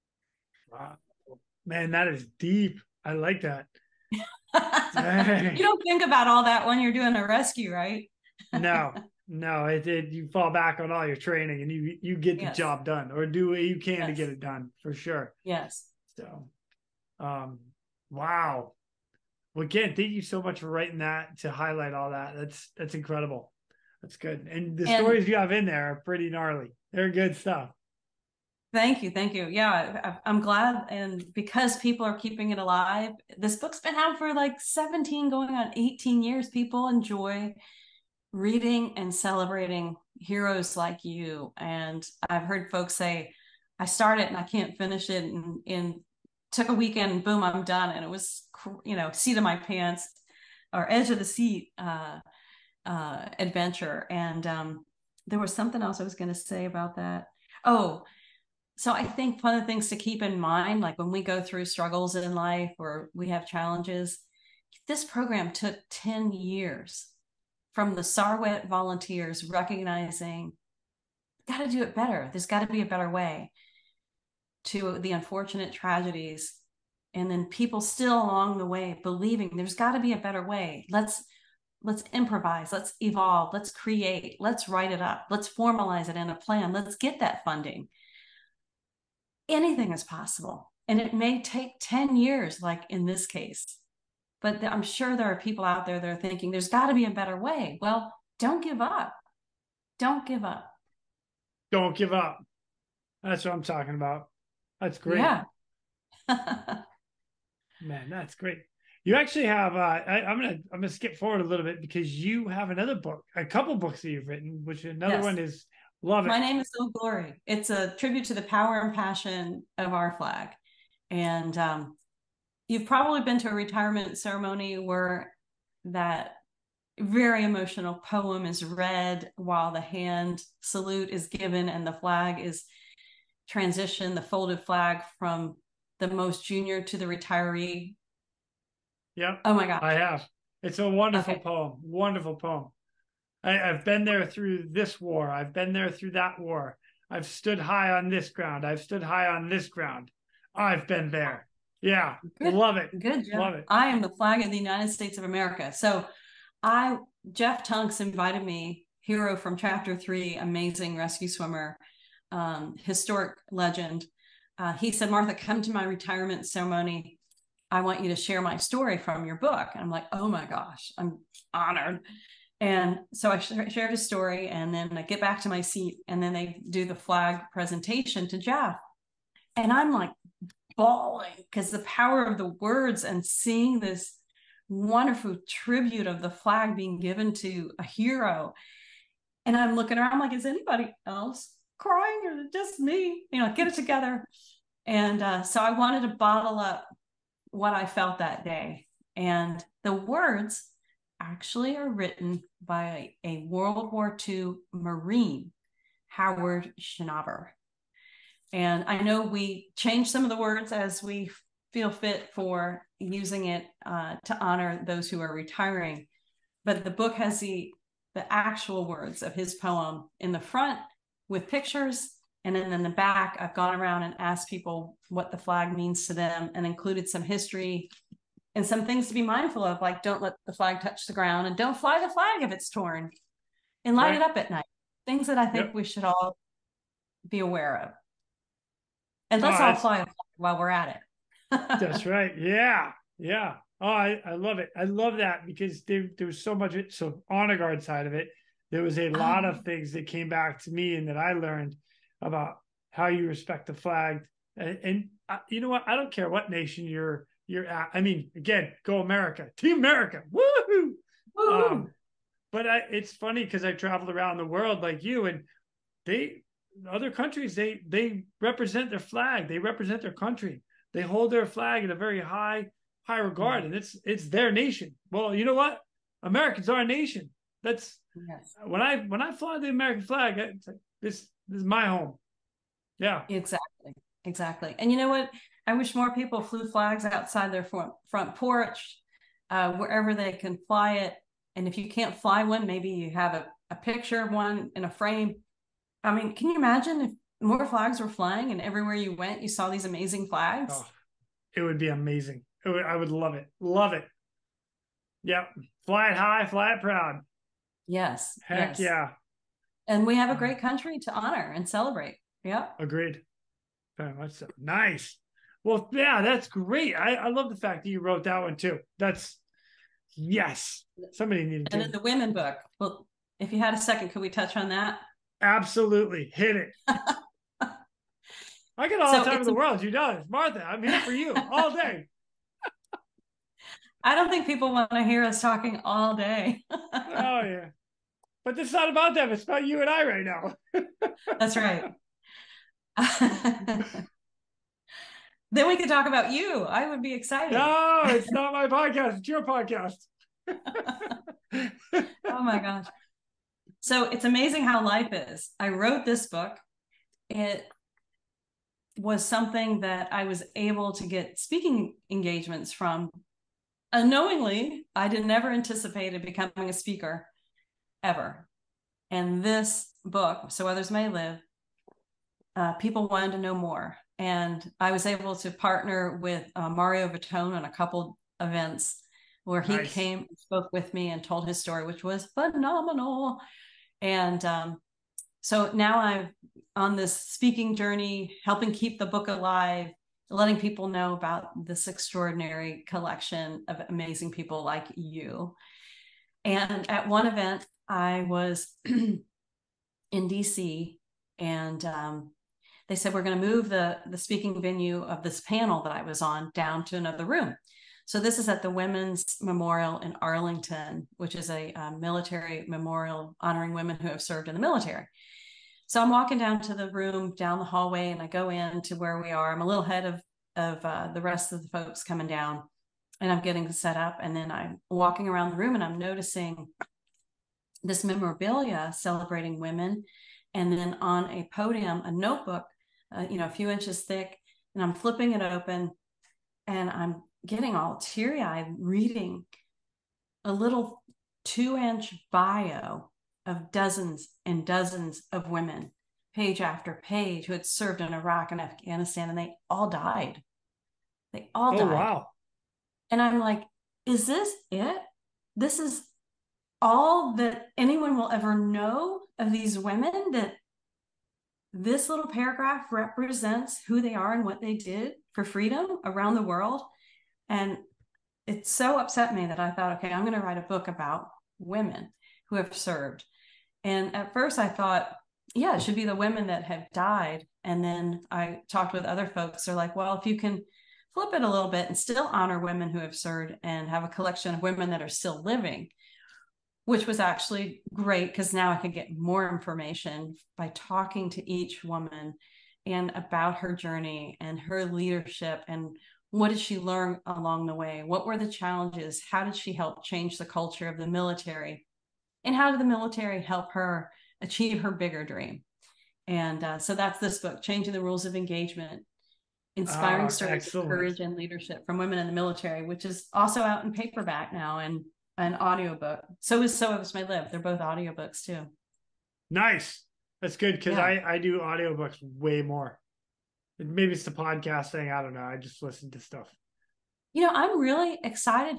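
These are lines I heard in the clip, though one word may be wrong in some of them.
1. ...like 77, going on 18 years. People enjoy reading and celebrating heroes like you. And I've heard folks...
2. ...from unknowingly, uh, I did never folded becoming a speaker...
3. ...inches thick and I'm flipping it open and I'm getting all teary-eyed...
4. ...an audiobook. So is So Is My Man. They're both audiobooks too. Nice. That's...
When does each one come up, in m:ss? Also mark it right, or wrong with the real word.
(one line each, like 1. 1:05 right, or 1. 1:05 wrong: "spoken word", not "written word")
1. 0:34 wrong: "17", not "77"
2. 6:02 wrong: "anticipated", not "folded"
3. 7:13 right
4. 8:35 wrong: "Live", not "Man".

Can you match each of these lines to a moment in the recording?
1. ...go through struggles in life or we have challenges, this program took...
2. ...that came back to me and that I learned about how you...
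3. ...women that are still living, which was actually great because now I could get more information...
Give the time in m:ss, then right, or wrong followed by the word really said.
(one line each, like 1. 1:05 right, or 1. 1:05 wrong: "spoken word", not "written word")
1. 1:01 right
2. 4:09 right
3. 8:04 right.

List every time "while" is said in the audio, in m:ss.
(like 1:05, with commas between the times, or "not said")
2:09, 4:00.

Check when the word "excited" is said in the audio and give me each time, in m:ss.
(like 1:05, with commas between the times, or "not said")
5:47, 8:48.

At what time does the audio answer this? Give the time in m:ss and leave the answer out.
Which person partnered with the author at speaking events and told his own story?
6:16.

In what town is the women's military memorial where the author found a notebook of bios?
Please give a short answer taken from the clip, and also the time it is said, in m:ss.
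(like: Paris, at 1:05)
Arlington, at 6:50.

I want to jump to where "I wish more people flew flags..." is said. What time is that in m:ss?
4:45.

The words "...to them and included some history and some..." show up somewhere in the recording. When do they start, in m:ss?
3:46.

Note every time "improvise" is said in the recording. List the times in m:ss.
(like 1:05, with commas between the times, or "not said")
1:22.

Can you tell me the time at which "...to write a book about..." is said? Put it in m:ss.
7:50.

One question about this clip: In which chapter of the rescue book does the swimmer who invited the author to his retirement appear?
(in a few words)
Chapter three.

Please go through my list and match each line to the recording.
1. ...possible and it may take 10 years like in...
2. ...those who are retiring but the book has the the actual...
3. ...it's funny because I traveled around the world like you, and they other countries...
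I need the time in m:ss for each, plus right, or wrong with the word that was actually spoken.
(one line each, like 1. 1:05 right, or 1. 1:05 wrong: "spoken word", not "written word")
1. 1:30 right
2. 3:34 right
3. 4:22 right.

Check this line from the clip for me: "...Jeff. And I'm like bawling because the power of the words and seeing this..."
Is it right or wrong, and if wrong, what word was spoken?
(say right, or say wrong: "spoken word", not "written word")
right.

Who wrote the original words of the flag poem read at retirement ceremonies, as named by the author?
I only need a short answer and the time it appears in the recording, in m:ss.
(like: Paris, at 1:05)
Howard Schnauber, at 3:26.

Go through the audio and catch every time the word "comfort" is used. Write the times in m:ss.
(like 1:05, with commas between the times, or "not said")
not said.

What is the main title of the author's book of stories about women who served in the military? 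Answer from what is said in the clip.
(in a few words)
Changing the Rules of Engagement.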